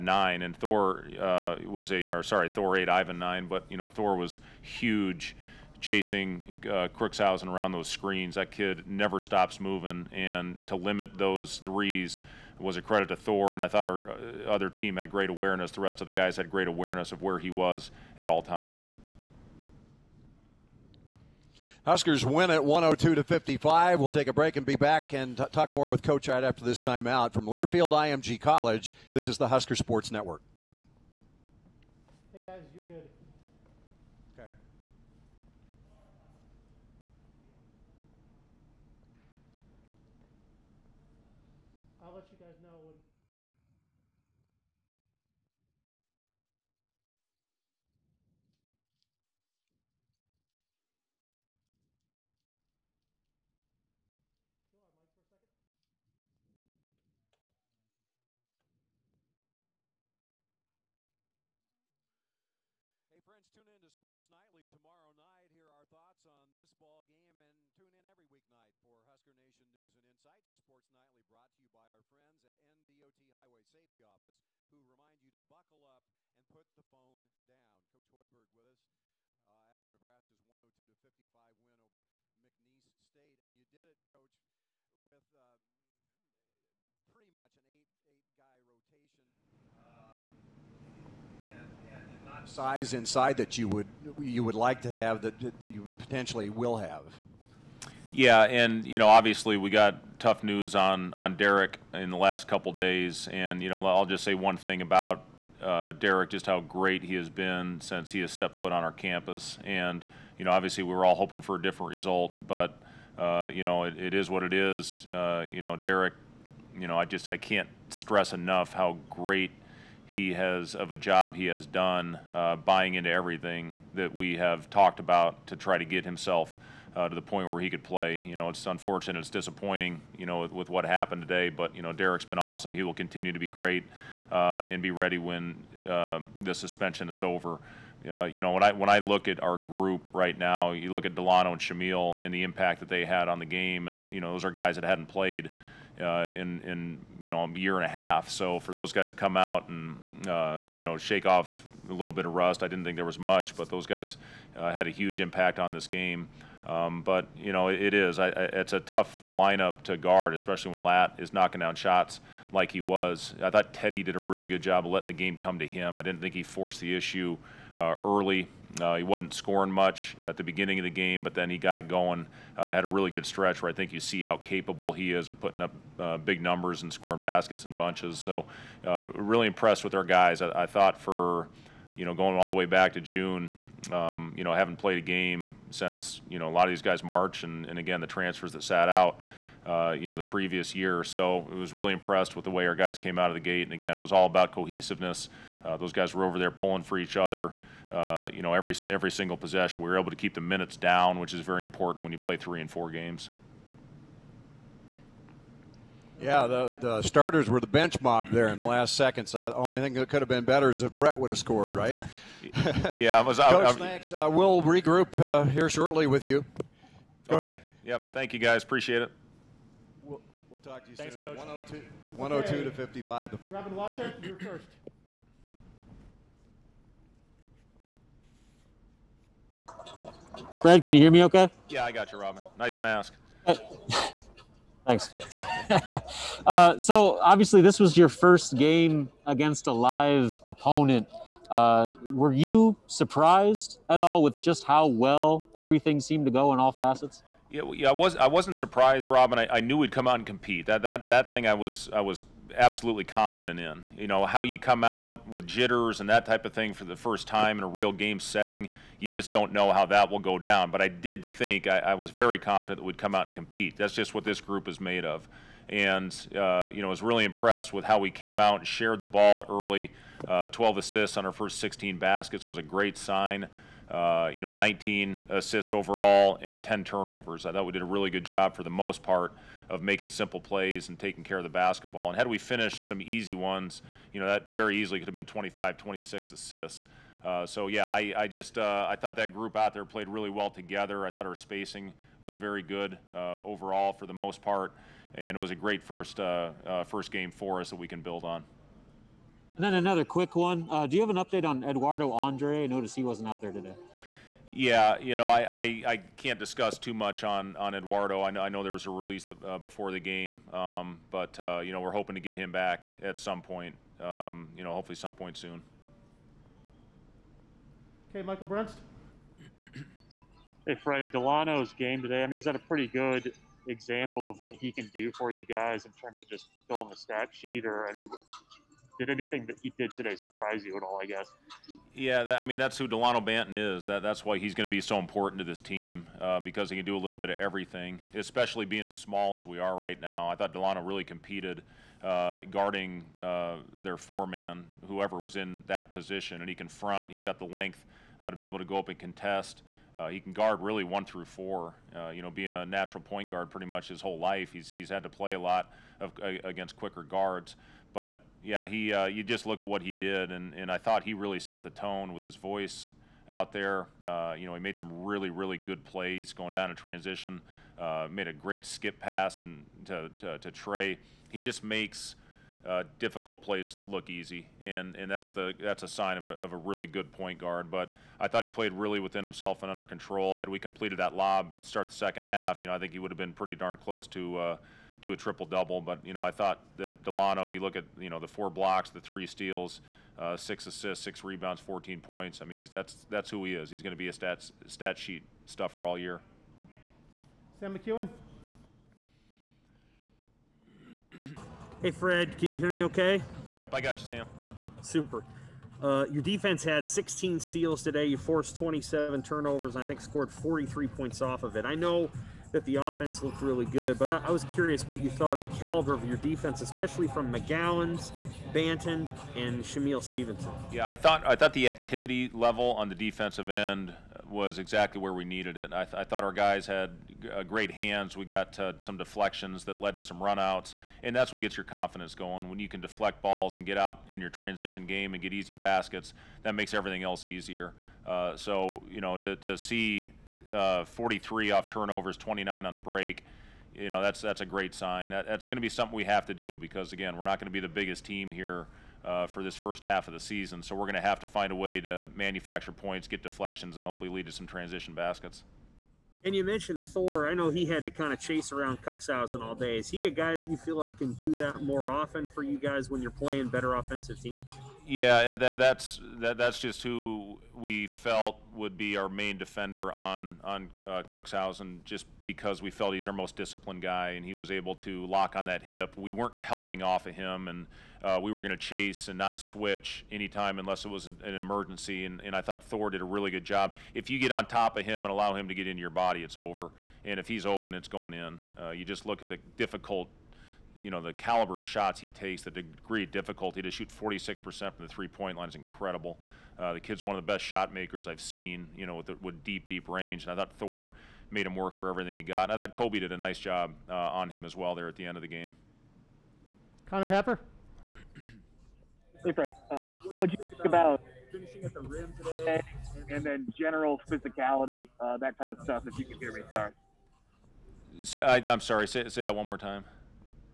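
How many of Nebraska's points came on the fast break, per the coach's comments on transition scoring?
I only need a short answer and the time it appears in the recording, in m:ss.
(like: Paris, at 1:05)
29, at 7:22.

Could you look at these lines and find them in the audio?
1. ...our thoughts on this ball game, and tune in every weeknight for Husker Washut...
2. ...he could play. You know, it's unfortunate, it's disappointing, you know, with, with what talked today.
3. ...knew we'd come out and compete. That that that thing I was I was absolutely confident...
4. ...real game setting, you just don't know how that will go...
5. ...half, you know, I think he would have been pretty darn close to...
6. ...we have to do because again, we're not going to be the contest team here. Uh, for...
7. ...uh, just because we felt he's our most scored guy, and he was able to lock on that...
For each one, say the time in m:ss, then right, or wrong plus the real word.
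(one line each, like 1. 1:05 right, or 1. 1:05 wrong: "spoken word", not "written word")
1. 1:05 wrong: "Nation", not "Washut"
2. 2:07 wrong: "happened", not "talked"
3. 4:09 right
4. 4:17 right
5. 6:22 right
6. 7:25 wrong: "biggest", not "contest"
7. 7:50 wrong: "disciplined", not "scored".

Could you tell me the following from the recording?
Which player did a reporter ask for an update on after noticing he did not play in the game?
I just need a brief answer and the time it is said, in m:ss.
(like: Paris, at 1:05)
Eduardo Andre, at 5:01.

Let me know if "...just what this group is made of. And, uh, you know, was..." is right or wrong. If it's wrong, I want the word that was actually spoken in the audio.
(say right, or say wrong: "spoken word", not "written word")
right.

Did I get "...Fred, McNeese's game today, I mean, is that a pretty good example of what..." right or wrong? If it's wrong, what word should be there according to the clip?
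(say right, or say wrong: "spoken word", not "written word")
wrong: "Delano", not "McNeese".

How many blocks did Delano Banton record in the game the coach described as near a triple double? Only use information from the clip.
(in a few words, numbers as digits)
4.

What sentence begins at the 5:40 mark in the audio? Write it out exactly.
I thought Delano really competed uh, guarding uh, their four man, whoever was in that position, and he can front.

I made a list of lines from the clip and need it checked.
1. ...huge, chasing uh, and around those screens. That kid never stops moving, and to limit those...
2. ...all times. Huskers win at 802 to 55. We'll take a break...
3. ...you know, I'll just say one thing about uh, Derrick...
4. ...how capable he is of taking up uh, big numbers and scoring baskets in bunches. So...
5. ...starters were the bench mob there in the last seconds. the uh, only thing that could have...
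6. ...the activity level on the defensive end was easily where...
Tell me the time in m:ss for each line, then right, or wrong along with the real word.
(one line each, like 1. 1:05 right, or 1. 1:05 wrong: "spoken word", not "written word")
1. 0:04 right
2. 0:18 wrong: "102", not "802"
3. 1:43 right
4. 2:54 wrong: "putting", not "taking"
5. 3:27 right
6. 7:01 wrong: "exactly", not "easily".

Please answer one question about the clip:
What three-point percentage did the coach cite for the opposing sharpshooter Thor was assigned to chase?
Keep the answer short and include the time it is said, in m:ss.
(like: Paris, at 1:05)
46%, at 8:13.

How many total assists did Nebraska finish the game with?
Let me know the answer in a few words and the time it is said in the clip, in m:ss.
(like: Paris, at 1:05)
19, at 4:34.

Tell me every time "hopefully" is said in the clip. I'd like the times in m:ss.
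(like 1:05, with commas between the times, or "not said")
5:14, 7:33.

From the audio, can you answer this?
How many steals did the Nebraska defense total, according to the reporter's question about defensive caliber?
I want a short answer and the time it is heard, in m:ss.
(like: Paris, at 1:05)
16, at 6:46.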